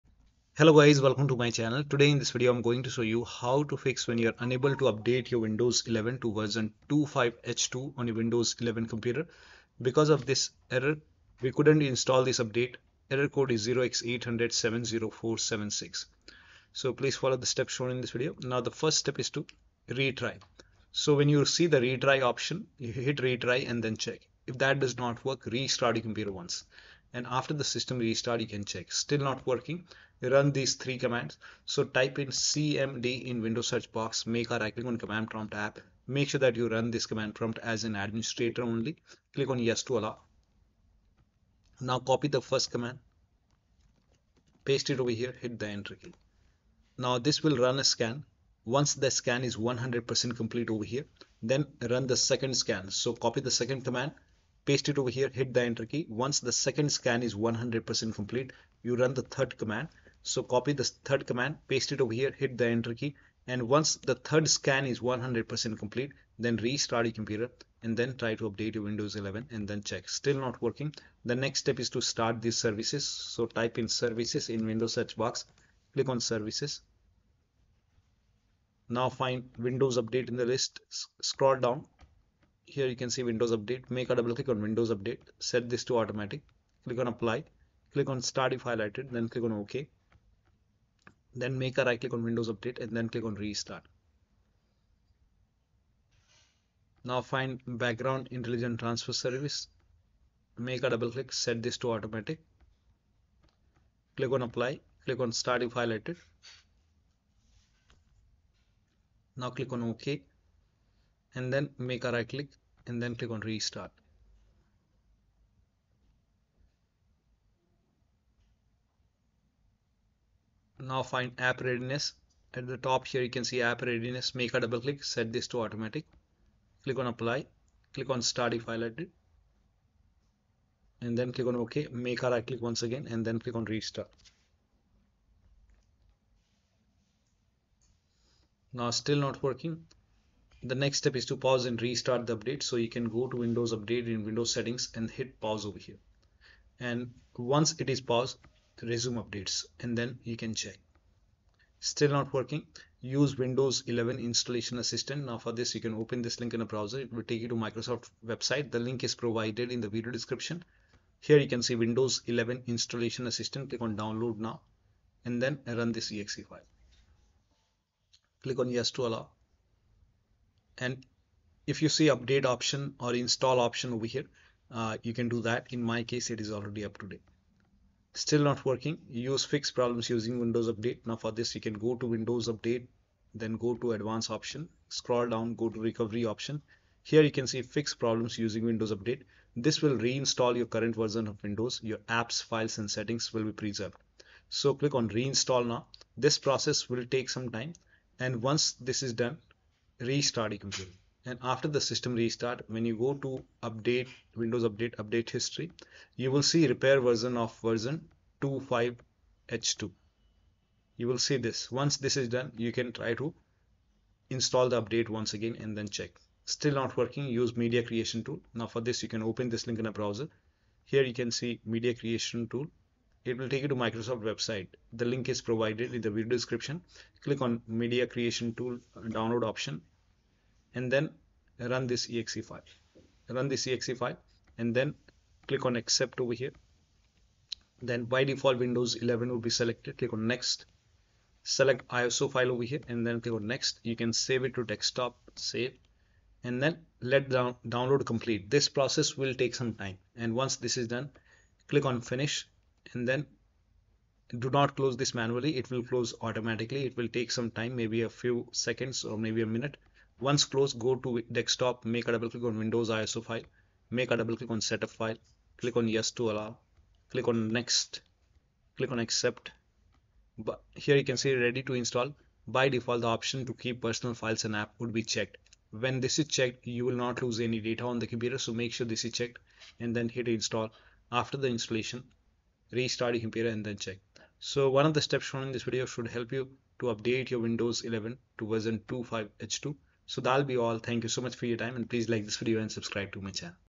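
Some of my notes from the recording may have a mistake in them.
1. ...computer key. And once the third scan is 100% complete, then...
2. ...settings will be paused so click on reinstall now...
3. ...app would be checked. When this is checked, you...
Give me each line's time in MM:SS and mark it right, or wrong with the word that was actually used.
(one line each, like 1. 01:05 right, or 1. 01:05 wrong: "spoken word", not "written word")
1. 01:02 wrong: "enter", not "computer"
2. 03:12 wrong: "preserved", not "paused"
3. 04:34 right.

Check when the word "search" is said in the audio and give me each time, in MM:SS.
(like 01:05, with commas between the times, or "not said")
00:33, 01:14.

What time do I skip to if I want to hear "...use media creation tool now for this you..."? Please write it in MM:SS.
03:37.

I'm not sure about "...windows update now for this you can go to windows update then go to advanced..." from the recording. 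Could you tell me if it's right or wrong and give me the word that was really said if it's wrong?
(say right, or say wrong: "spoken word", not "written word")
right.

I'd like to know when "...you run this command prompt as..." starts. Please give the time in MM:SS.
00:36.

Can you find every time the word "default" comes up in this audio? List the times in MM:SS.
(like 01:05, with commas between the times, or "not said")
03:58, 04:32.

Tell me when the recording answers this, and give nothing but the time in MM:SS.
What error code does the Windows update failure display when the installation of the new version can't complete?
00:13.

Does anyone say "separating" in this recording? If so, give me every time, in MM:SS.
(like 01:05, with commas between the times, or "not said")
not said.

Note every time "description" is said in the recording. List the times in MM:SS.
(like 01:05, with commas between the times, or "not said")
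02:40, 03:46.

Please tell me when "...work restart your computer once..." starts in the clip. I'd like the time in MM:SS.
00:25.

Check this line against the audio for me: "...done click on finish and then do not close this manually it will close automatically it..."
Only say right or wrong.
right.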